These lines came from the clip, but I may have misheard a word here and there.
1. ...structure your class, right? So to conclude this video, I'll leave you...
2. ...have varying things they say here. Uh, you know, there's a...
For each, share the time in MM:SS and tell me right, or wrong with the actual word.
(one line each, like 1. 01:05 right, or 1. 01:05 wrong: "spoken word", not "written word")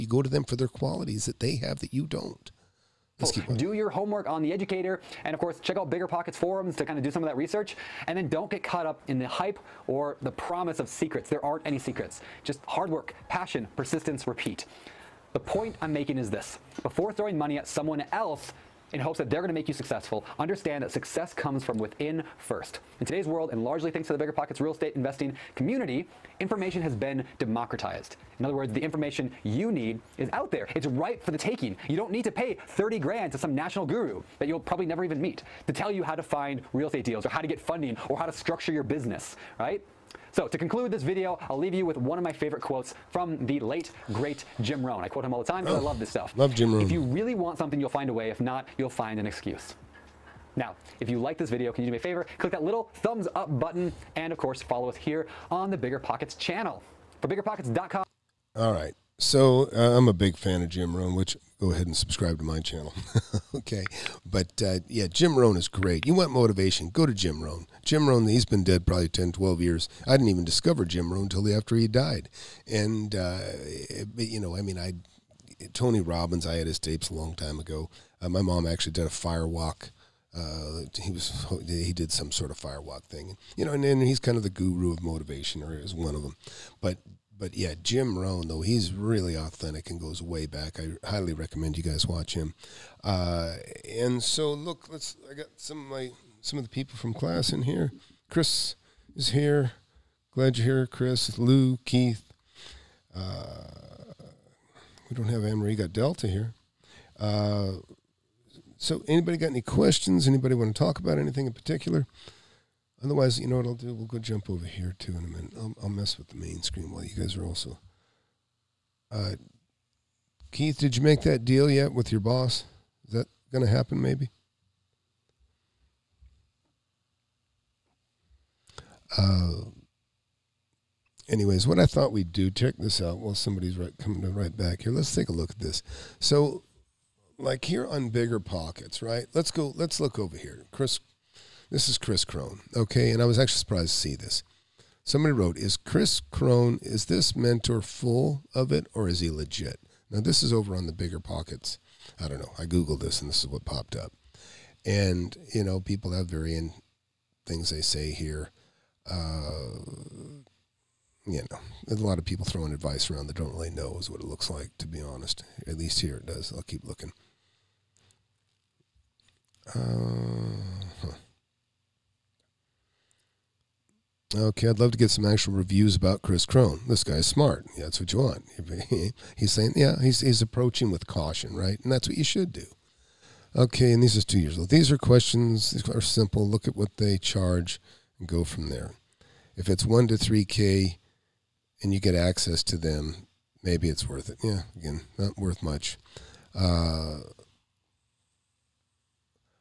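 1. 00:38 wrong: "business", not "class"
2. 02:36 right.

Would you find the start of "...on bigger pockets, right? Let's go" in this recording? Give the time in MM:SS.
02:17.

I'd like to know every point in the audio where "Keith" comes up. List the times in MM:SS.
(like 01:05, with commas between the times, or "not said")
01:41, 02:00.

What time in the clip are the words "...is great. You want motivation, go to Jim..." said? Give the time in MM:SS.
01:05.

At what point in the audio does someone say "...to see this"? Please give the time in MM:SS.
02:23.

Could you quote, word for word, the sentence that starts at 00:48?
If not, you'll find an excuse.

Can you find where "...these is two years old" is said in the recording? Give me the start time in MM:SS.
03:04.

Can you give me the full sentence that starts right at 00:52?
Click that little thumbs up button and, of course, follow us here on the Bigger Pockets channel.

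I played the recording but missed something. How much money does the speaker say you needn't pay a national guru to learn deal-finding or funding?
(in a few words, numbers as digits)
30 grand.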